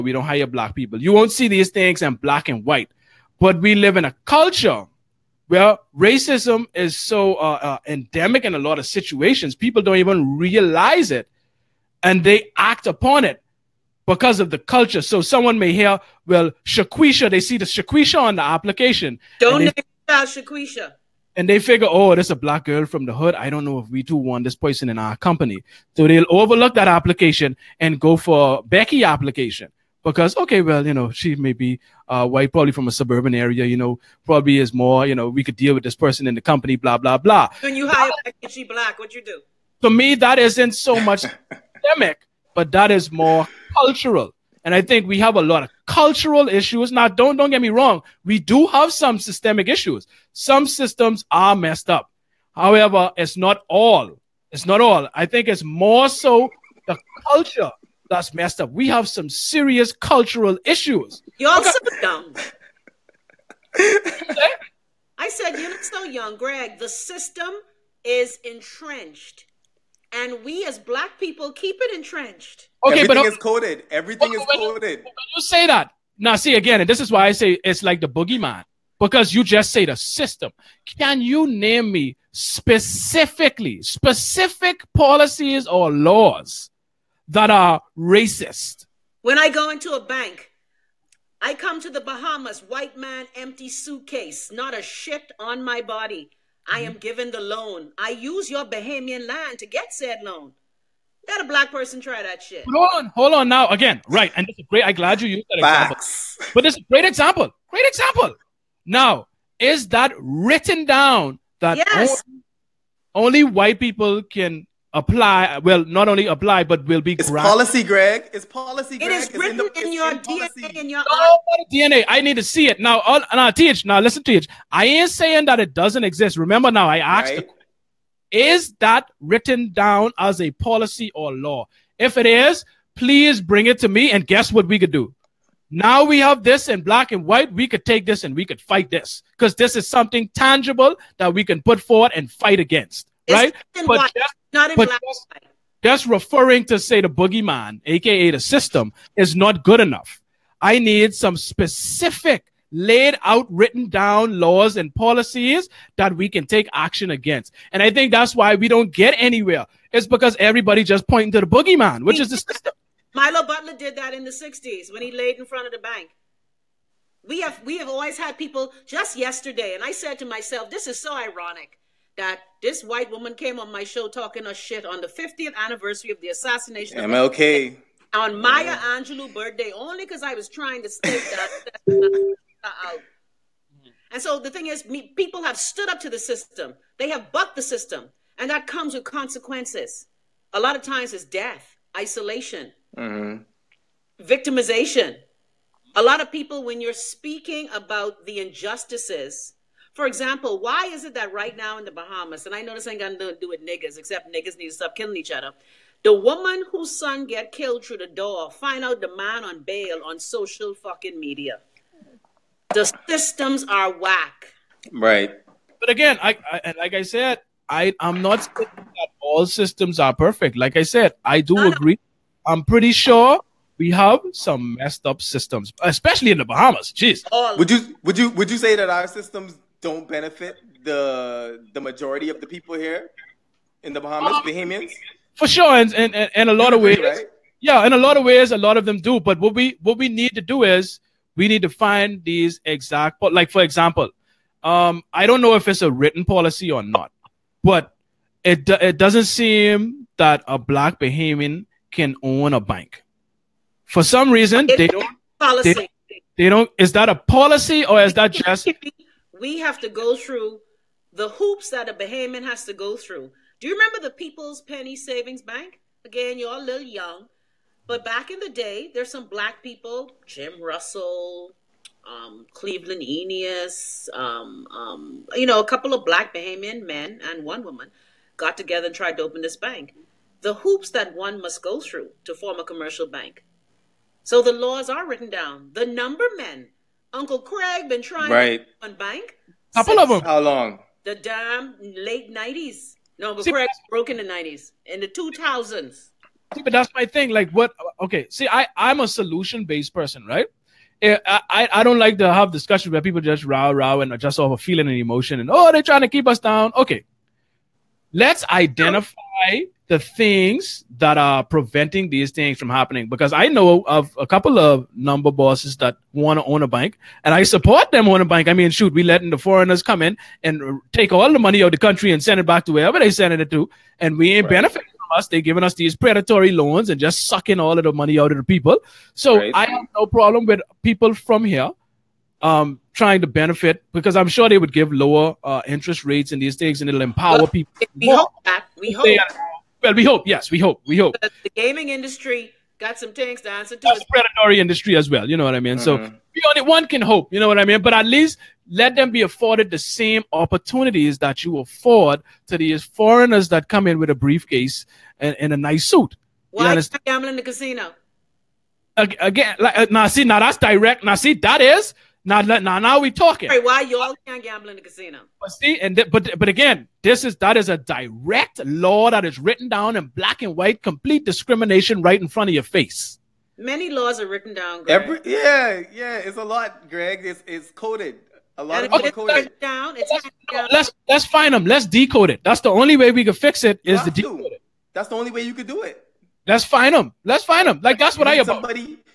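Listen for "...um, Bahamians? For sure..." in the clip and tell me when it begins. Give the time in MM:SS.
03:54.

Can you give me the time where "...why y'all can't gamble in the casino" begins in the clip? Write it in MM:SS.
06:03.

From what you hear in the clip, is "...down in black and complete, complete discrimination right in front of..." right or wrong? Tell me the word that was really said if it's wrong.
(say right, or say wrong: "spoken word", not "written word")
wrong: "white", not "complete".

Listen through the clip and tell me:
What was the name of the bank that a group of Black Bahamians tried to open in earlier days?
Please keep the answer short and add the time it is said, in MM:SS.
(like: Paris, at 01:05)
People's Penny Savings Bank, at 04:24.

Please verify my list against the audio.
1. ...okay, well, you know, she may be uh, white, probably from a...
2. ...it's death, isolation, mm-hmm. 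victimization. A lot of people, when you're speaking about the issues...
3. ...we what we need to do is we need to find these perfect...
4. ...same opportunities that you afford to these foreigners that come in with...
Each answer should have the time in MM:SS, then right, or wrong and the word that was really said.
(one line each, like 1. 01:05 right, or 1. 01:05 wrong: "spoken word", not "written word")
1. 00:30 right
2. 03:11 wrong: "injustices", not "issues"
3. 03:59 wrong: "exact", not "perfect"
4. 05:49 right.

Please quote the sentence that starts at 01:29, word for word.
When I go into a bank, I come to the Bahamas, white man, empty suitcase, not a shit on my body.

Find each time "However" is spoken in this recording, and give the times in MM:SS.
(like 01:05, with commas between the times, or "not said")
00:52.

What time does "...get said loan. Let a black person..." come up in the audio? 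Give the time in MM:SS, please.
01:39.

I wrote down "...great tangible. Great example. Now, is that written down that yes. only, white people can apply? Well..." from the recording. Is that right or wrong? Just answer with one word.
wrong.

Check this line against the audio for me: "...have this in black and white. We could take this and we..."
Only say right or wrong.
right.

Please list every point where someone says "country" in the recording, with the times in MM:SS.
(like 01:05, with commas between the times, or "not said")
05:21.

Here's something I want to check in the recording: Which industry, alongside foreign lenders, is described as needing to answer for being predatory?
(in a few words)
gaming industry.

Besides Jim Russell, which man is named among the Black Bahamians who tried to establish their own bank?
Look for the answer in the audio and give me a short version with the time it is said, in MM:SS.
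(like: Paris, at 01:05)
Cleveland Eneas, at 04:32.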